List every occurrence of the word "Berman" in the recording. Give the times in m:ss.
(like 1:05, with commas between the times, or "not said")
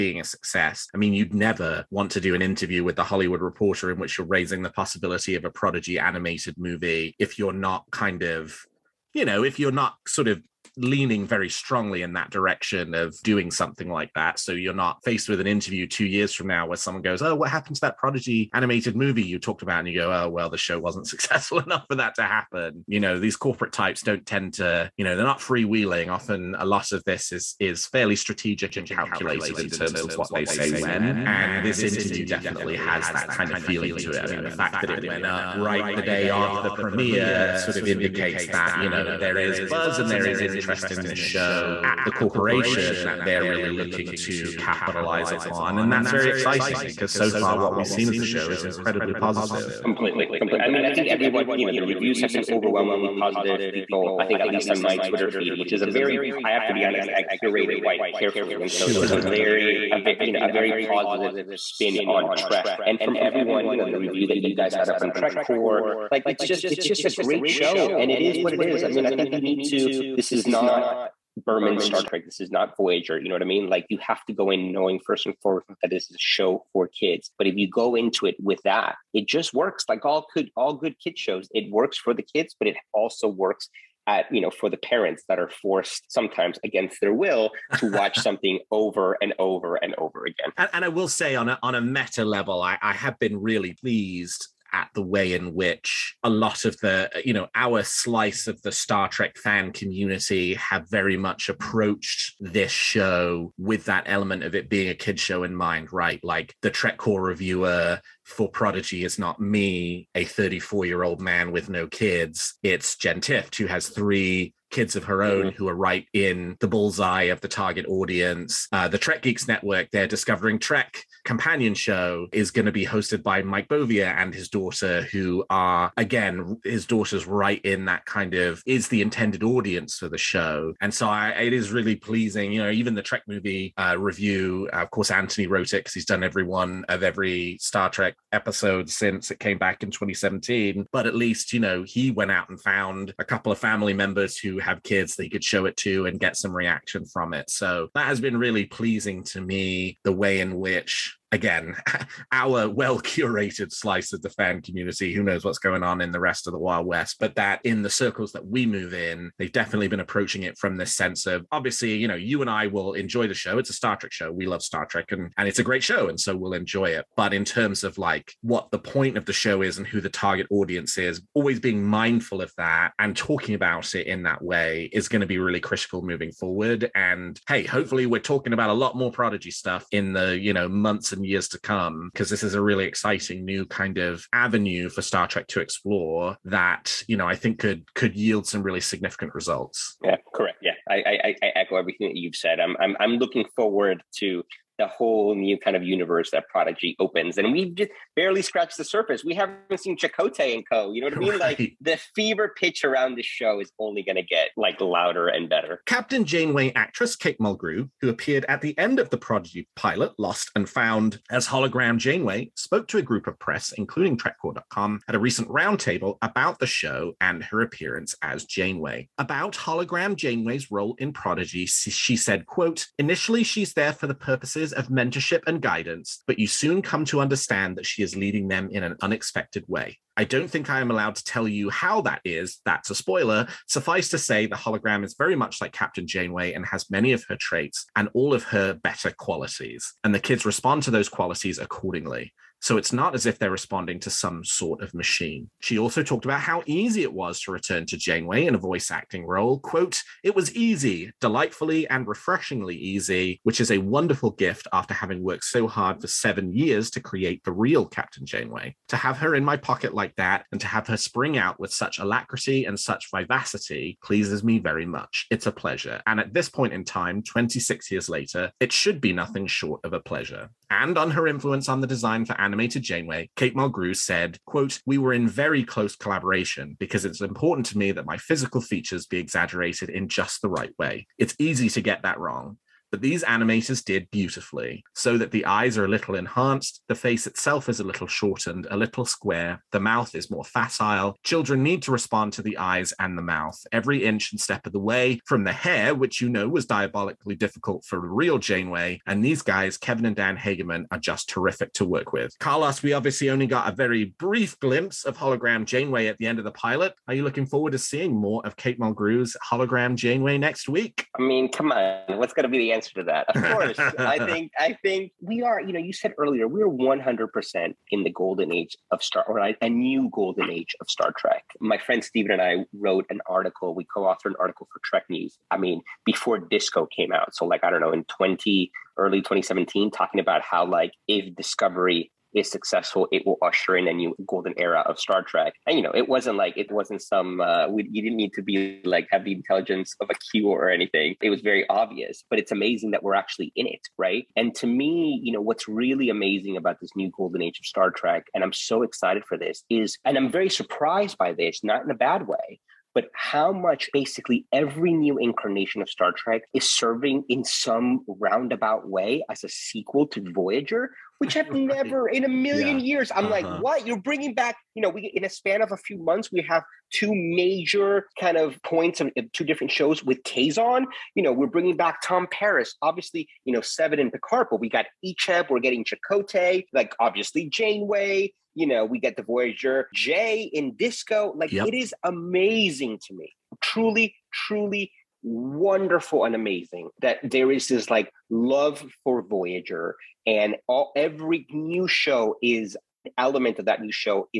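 1:11.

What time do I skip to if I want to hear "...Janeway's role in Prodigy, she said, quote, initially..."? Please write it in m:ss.
3:40.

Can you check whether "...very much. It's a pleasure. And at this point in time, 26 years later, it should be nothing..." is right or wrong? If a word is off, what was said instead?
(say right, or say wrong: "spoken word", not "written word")
right.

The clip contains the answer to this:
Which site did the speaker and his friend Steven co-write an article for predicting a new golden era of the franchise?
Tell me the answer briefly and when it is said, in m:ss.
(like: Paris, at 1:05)
Trek News, at 5:24.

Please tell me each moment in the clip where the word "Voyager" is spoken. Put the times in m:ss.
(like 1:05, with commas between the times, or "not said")
1:12, 6:00, 6:19, 6:29.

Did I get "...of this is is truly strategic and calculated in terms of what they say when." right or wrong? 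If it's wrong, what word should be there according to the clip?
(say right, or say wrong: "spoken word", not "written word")
wrong: "fairly", not "truly".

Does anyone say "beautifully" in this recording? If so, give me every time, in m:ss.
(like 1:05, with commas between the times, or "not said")
4:44.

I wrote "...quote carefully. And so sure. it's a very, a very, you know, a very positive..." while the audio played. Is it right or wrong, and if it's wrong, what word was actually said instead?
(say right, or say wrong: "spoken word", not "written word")
wrong: "quite", not "quote".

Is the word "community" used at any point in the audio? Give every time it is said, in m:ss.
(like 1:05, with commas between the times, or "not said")
1:39, 2:34.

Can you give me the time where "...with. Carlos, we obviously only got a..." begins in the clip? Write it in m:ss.
5:02.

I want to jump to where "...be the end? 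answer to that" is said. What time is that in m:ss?
5:12.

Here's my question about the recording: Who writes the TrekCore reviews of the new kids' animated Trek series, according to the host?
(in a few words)
Jen Tift.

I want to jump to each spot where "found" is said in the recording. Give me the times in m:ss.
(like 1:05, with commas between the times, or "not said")
2:22, 3:30.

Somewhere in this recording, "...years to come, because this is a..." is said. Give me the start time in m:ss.
3:01.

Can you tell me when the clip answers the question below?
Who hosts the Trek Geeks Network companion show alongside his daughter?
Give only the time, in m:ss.
2:03.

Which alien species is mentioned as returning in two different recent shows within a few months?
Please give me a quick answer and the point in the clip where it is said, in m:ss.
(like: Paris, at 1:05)
Kazon, at 6:10.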